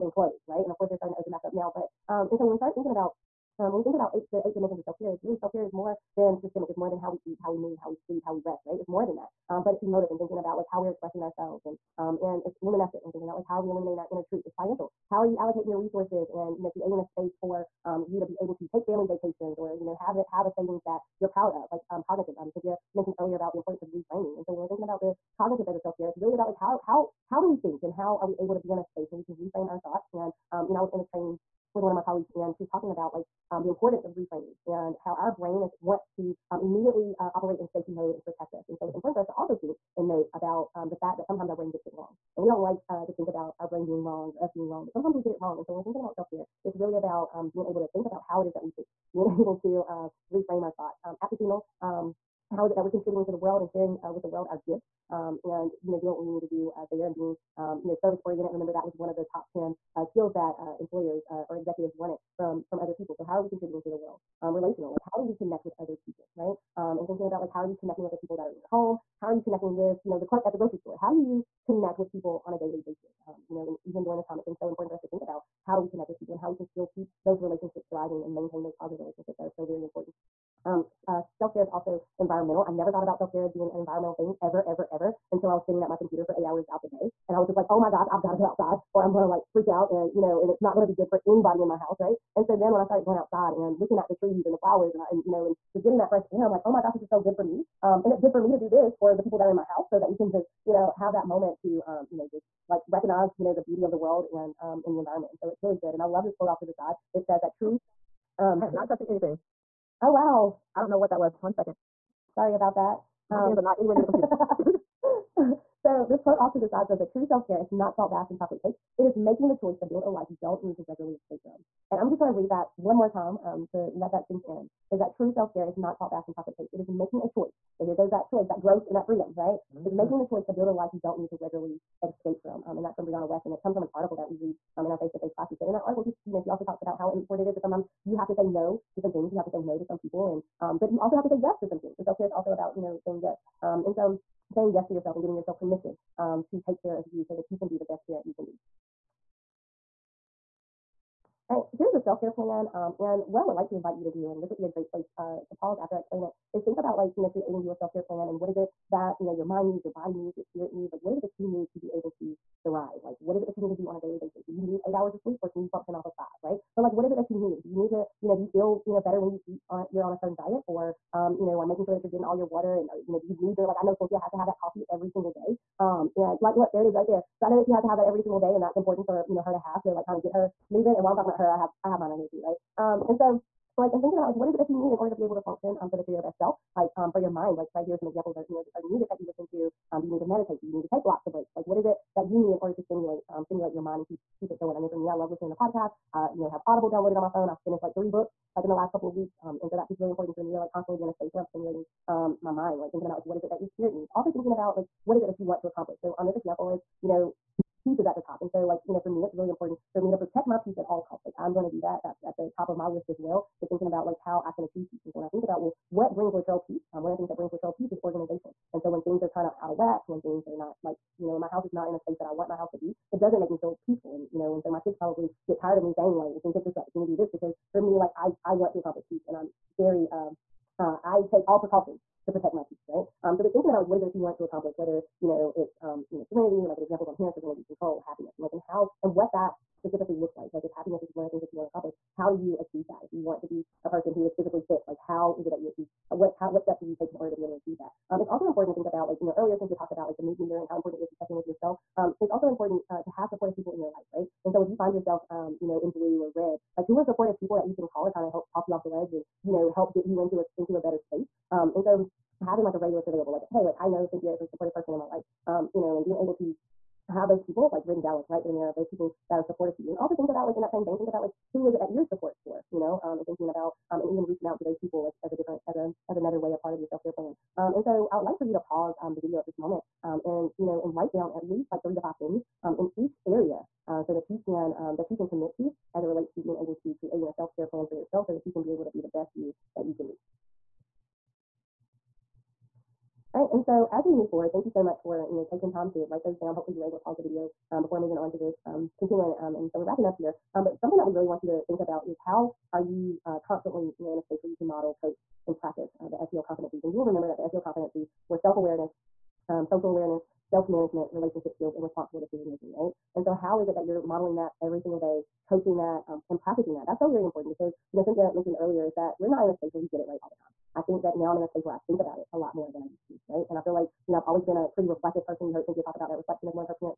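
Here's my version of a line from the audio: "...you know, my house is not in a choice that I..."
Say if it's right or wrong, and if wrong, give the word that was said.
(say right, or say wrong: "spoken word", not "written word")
wrong: "space", not "choice".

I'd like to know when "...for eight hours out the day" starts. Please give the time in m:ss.
1:26.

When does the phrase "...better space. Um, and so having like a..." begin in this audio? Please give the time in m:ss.
4:20.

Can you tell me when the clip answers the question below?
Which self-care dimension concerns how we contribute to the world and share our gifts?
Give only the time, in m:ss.
0:51.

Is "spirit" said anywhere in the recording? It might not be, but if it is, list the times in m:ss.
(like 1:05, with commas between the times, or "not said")
2:40, 3:23.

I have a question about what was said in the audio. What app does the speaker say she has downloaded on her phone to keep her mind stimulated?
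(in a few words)
Audible.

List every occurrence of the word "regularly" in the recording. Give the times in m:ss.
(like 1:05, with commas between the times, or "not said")
2:00, 2:11.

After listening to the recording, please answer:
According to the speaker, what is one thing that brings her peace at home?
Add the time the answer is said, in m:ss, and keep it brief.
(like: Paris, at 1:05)
organization, at 3:38.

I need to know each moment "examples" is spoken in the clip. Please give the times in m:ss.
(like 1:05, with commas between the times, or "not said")
3:08, 3:26, 3:56.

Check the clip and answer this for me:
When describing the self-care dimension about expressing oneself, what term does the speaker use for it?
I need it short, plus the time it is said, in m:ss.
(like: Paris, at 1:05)
emotive, at 0:09.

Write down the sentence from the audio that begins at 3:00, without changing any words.
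And while I'm talking about her, I have I have mine right here too, right?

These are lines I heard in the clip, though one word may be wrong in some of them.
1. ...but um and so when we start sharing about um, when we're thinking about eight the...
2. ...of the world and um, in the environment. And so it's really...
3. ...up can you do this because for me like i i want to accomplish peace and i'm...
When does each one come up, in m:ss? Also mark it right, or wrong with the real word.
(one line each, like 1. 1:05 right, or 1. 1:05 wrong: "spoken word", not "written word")
1. 0:01 wrong: "thinking", not "sharing"
2. 1:43 right
3. 3:46 right.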